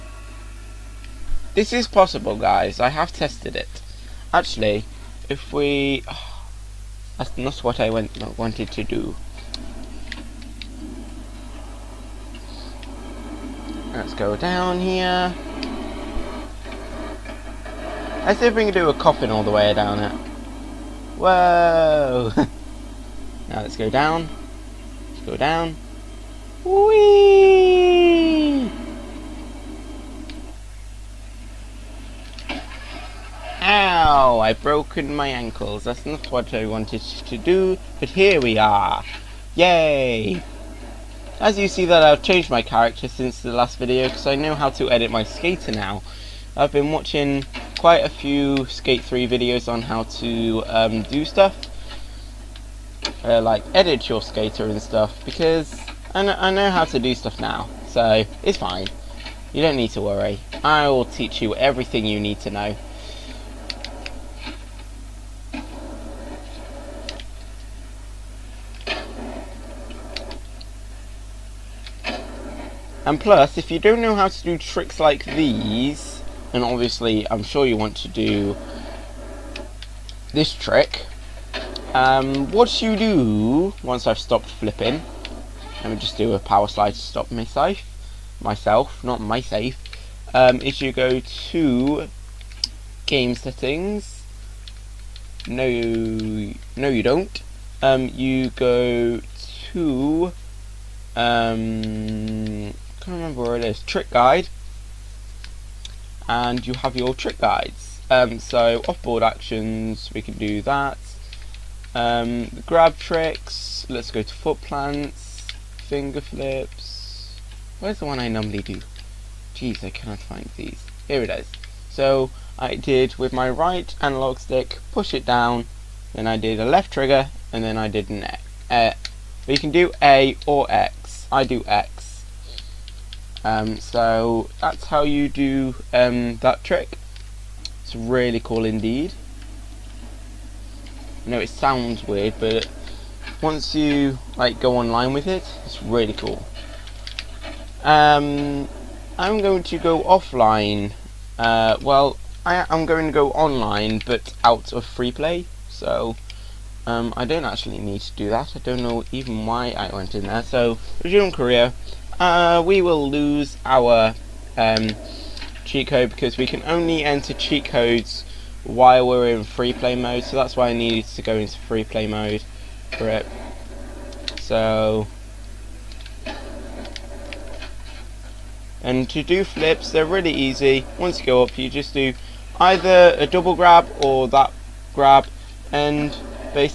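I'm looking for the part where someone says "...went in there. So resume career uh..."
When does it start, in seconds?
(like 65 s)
159 s.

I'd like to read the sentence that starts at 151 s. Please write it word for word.
Uh, well, I, am going to go online, but out of free play.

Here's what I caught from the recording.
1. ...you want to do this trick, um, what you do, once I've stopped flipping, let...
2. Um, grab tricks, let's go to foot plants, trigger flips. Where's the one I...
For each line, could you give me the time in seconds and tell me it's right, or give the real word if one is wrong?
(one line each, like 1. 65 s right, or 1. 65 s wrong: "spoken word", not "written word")
1. 77 s right
2. 111 s wrong: "finger", not "trigger".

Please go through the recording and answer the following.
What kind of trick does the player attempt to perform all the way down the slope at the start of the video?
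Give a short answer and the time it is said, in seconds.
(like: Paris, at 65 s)
coffin, at 18 s.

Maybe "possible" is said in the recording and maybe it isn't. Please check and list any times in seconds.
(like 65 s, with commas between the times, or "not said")
1 s.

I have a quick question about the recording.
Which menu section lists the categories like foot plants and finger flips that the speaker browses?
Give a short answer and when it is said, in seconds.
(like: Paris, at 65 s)
trick guide, at 103 s.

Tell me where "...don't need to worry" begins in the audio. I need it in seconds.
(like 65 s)
59 s.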